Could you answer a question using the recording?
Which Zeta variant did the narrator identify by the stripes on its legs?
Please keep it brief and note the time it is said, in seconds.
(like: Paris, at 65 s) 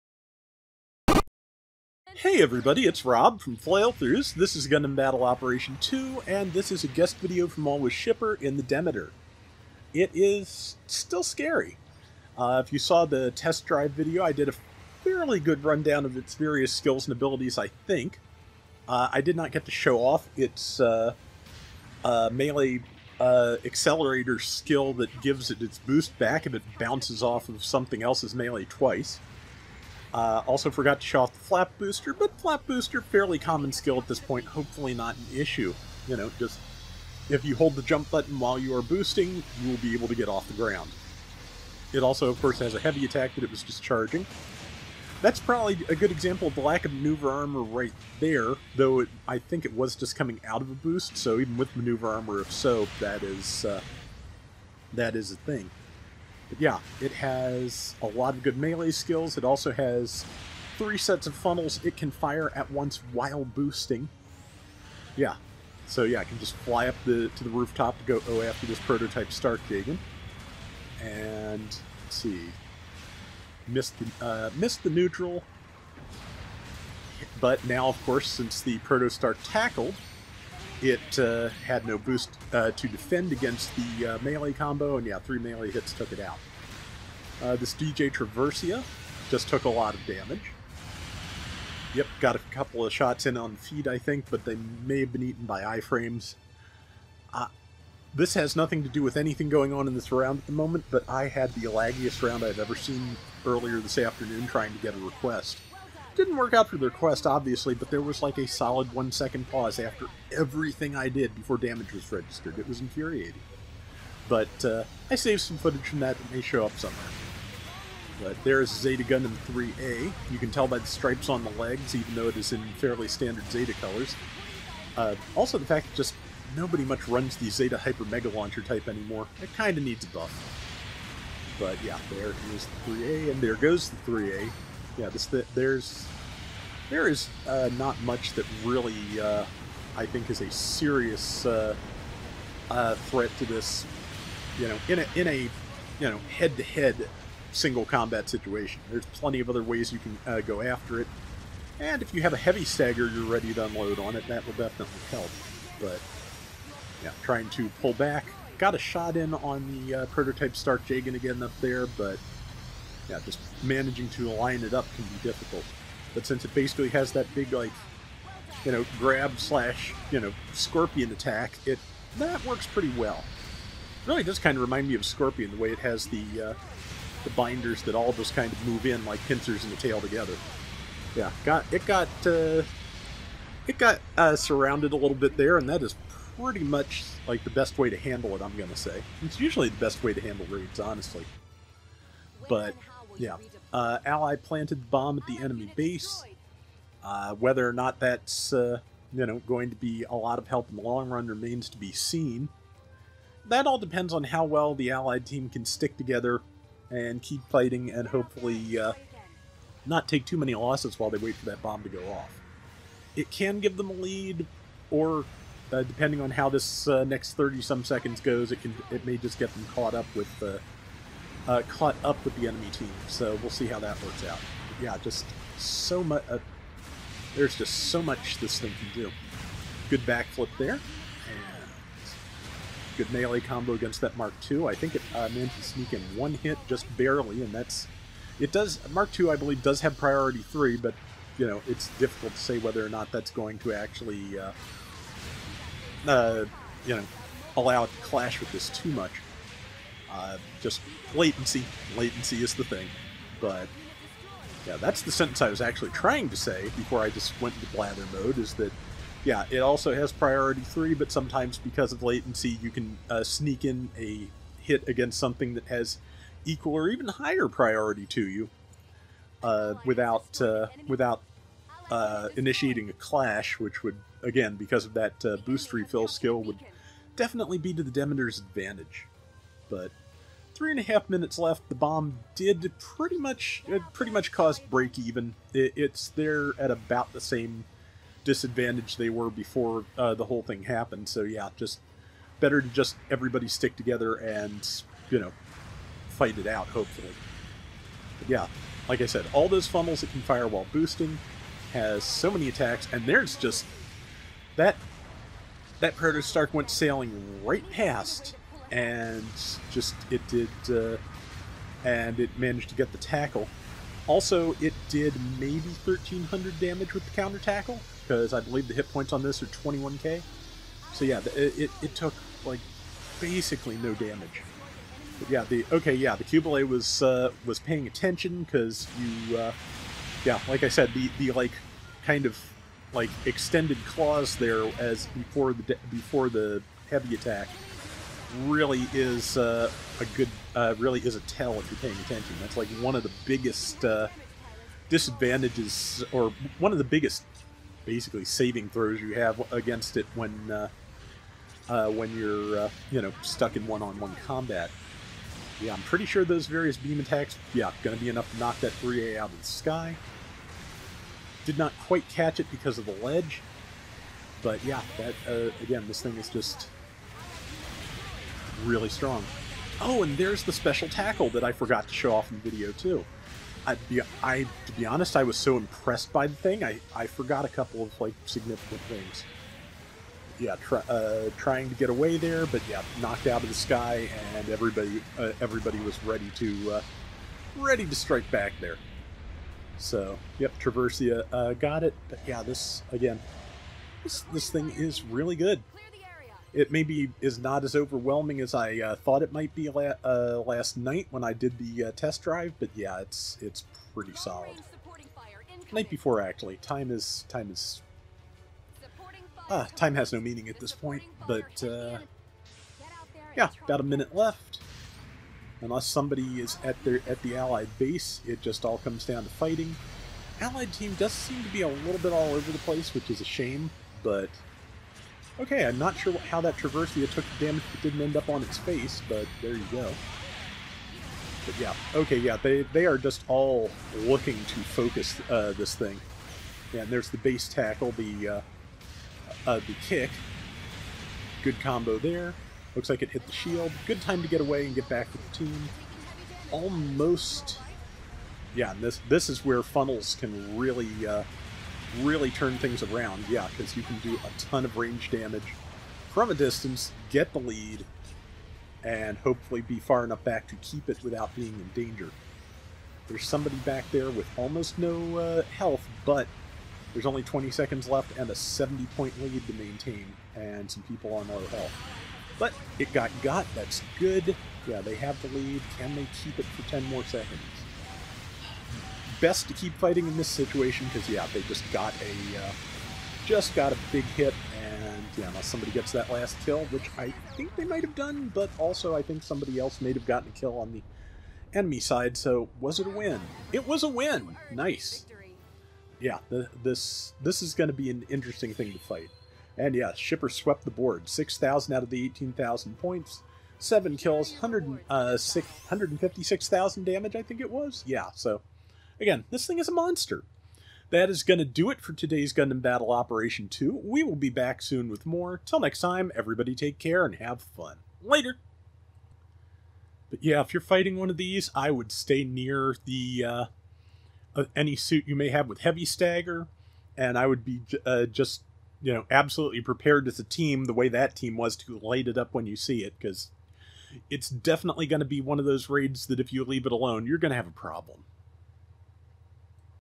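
Zeta Gundam 3A, at 118 s.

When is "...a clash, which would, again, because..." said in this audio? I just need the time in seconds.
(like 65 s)
272 s.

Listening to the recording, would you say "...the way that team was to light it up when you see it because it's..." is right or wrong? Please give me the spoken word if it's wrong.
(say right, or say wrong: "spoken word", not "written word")
right.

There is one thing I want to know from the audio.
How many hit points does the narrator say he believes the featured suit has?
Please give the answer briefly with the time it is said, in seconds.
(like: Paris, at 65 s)
21k, at 319 s.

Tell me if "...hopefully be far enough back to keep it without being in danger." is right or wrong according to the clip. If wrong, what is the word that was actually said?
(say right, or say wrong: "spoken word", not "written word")
right.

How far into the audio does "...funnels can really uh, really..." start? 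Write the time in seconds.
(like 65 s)
449 s.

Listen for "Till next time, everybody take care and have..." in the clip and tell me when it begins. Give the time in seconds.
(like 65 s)
515 s.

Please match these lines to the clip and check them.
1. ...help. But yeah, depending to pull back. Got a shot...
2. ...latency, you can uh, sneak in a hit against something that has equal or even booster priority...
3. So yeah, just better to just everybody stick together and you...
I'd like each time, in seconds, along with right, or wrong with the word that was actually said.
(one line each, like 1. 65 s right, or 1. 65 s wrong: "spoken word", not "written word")
1. 155 s wrong: "trying", not "depending"
2. 262 s wrong: "higher", not "booster"
3. 291 s right.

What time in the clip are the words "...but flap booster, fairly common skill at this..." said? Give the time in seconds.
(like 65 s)
32 s.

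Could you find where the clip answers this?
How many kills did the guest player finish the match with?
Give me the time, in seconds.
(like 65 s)
503 s.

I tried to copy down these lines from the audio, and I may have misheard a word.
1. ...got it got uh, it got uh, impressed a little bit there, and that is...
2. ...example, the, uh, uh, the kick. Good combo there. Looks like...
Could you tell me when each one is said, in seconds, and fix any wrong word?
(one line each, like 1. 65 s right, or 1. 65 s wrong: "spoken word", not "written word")
1. 181 s wrong: "surrounded", not "impressed"
2. 437 s wrong: "tackle", not "example".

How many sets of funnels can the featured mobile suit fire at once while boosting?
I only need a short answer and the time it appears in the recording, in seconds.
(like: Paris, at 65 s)
3, at 60 s.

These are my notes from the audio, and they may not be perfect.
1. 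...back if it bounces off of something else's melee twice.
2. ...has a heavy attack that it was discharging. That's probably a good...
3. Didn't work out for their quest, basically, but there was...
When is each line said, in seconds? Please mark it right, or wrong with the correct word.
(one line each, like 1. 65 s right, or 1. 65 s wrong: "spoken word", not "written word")
1. 26 s right
2. 42 s right
3. 106 s wrong: "obviously", not "basically".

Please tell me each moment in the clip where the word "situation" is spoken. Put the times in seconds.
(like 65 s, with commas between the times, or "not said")
148 s, 480 s.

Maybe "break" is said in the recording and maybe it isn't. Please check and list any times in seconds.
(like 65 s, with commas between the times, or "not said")
284 s.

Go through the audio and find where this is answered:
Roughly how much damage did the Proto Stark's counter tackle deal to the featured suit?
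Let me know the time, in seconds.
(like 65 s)
315 s.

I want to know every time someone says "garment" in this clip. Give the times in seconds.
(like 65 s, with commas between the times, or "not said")
not said.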